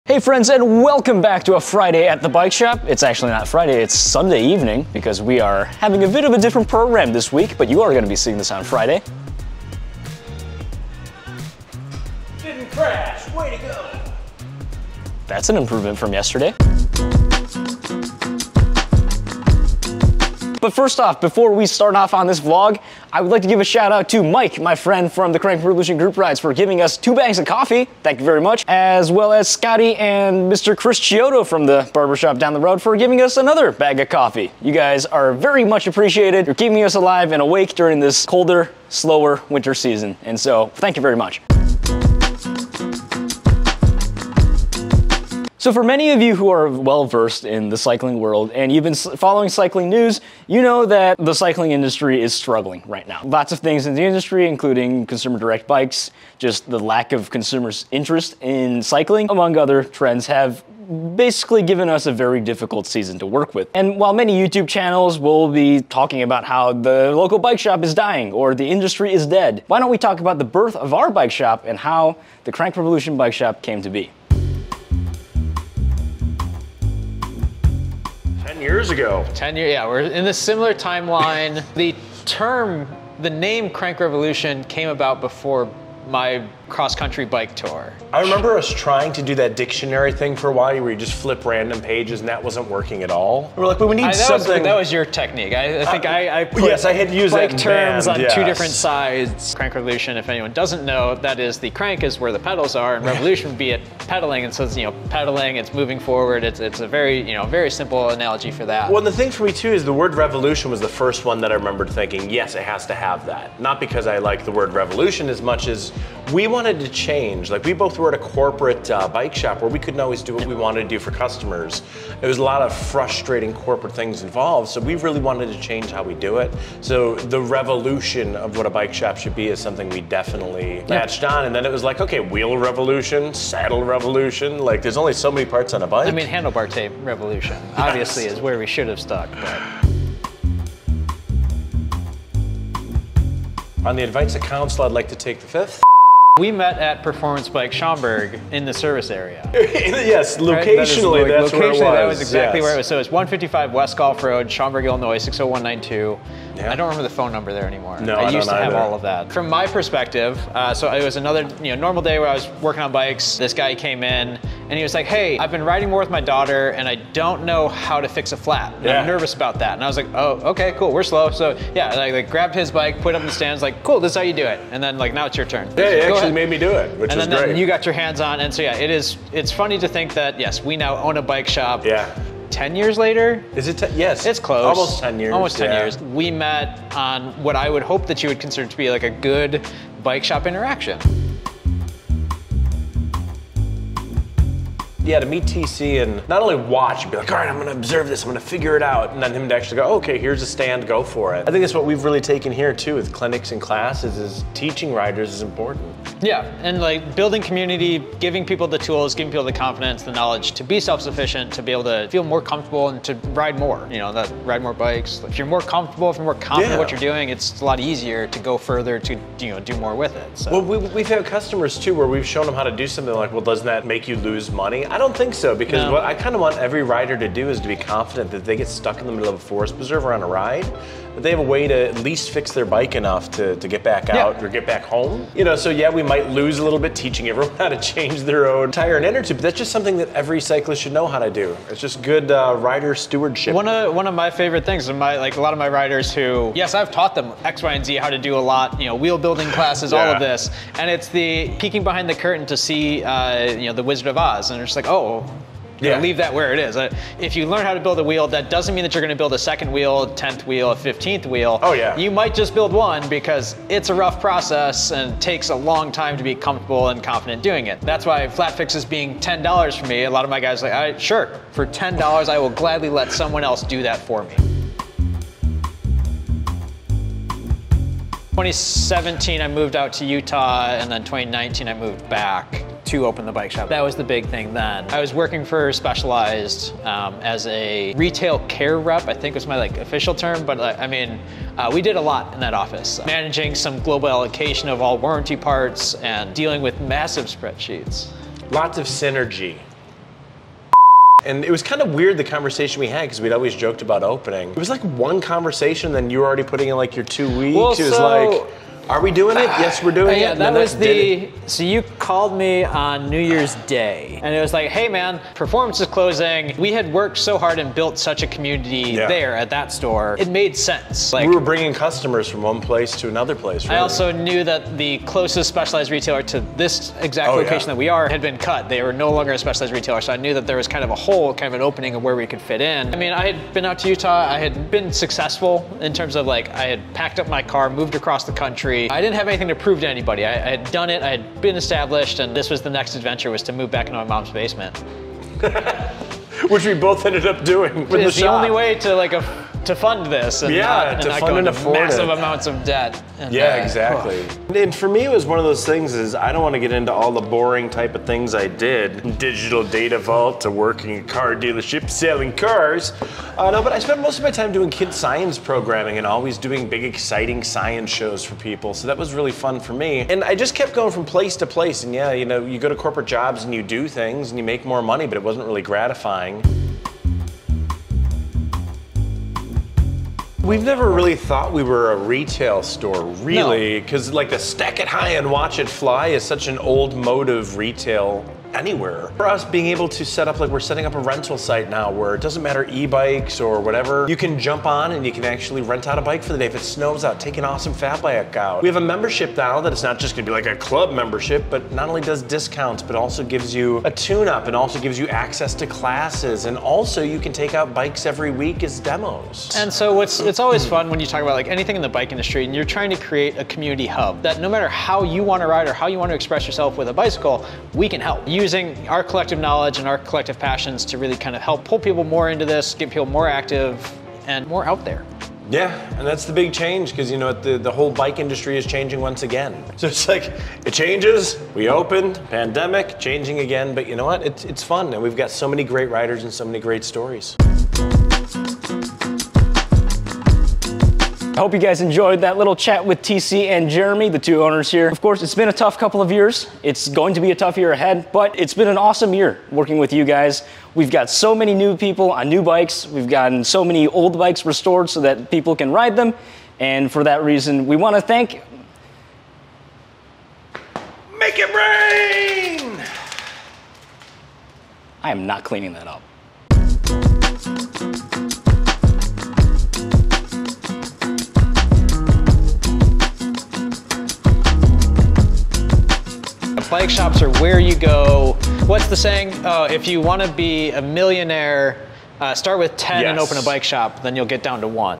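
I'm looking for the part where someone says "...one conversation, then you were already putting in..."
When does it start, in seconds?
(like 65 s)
304 s.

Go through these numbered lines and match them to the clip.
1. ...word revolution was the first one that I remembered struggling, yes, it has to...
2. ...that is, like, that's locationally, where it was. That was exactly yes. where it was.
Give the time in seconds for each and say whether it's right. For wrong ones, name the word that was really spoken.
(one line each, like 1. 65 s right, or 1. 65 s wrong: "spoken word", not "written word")
1. 109 s wrong: "thinking", not "struggling"
2. 150 s right.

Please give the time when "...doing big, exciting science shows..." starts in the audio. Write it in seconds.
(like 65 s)
366 s.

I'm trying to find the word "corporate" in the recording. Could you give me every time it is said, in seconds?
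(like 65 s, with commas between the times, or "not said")
118 s, 123 s, 372 s.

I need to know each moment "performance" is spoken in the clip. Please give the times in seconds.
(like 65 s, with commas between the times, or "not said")
147 s, 315 s.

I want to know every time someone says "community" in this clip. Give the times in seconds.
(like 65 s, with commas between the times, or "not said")
207 s, 318 s, 413 s.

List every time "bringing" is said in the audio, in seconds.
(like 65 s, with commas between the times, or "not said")
321 s.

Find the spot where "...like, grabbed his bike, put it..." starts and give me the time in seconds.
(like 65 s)
172 s.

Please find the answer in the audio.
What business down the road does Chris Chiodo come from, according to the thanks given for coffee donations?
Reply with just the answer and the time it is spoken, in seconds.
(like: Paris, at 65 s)
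barbershop, at 31 s.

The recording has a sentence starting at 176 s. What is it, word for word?
made me do it, which and was then, great.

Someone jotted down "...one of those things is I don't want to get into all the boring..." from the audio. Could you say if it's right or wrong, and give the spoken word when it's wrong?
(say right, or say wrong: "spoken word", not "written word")
right.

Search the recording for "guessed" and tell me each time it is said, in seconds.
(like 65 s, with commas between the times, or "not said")
not said.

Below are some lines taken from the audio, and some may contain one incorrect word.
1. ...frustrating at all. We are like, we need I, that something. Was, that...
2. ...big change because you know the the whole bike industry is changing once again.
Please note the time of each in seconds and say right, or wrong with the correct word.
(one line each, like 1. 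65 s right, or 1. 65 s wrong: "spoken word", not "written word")
1. 92 s wrong: "working", not "frustrating"
2. 426 s right.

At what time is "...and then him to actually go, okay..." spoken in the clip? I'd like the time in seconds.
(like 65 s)
199 s.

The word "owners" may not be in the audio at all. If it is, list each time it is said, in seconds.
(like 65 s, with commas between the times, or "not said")
444 s.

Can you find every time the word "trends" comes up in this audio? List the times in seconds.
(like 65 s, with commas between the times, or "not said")
59 s.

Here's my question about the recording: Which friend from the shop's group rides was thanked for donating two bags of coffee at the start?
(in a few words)
Mike.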